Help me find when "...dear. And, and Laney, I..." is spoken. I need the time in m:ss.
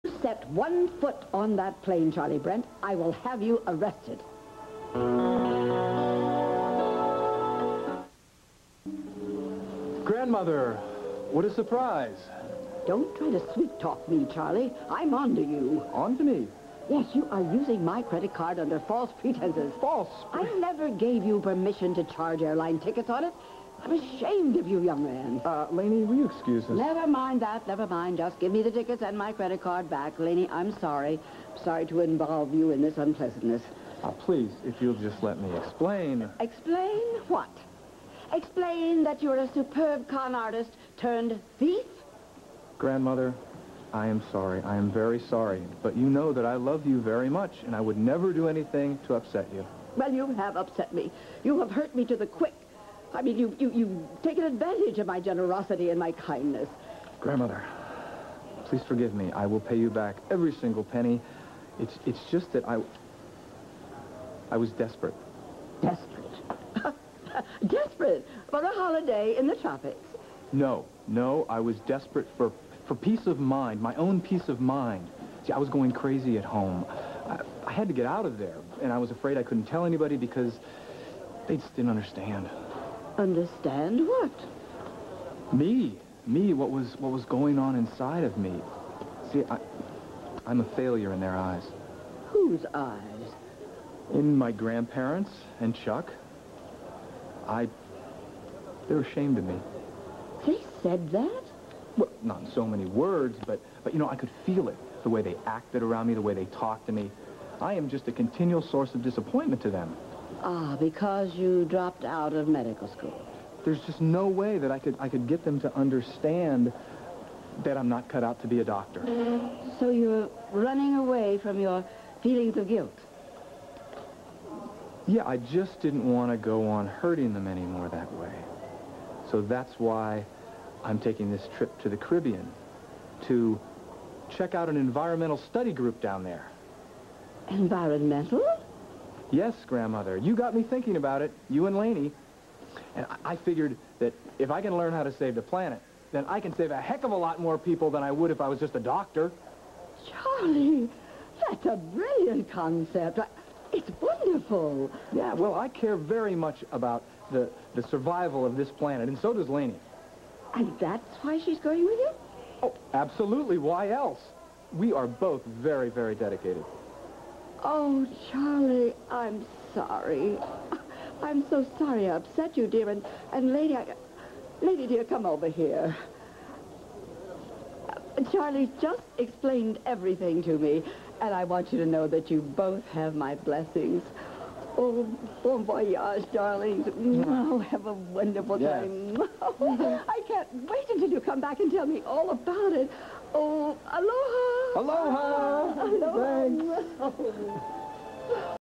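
2:52.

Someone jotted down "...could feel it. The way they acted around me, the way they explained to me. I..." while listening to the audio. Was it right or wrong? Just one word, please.
wrong.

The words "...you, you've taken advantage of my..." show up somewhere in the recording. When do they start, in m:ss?
0:53.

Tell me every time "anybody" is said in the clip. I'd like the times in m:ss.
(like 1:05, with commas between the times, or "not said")
1:19.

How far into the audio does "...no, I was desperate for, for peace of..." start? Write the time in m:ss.
1:11.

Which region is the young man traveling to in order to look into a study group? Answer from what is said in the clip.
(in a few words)
the Caribbean.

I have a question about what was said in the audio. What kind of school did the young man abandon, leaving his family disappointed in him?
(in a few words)
medical school.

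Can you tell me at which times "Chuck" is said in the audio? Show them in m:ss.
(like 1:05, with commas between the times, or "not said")
1:35.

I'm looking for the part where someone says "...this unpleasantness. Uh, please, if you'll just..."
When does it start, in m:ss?
0:32.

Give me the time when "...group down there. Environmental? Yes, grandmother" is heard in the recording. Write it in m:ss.
2:15.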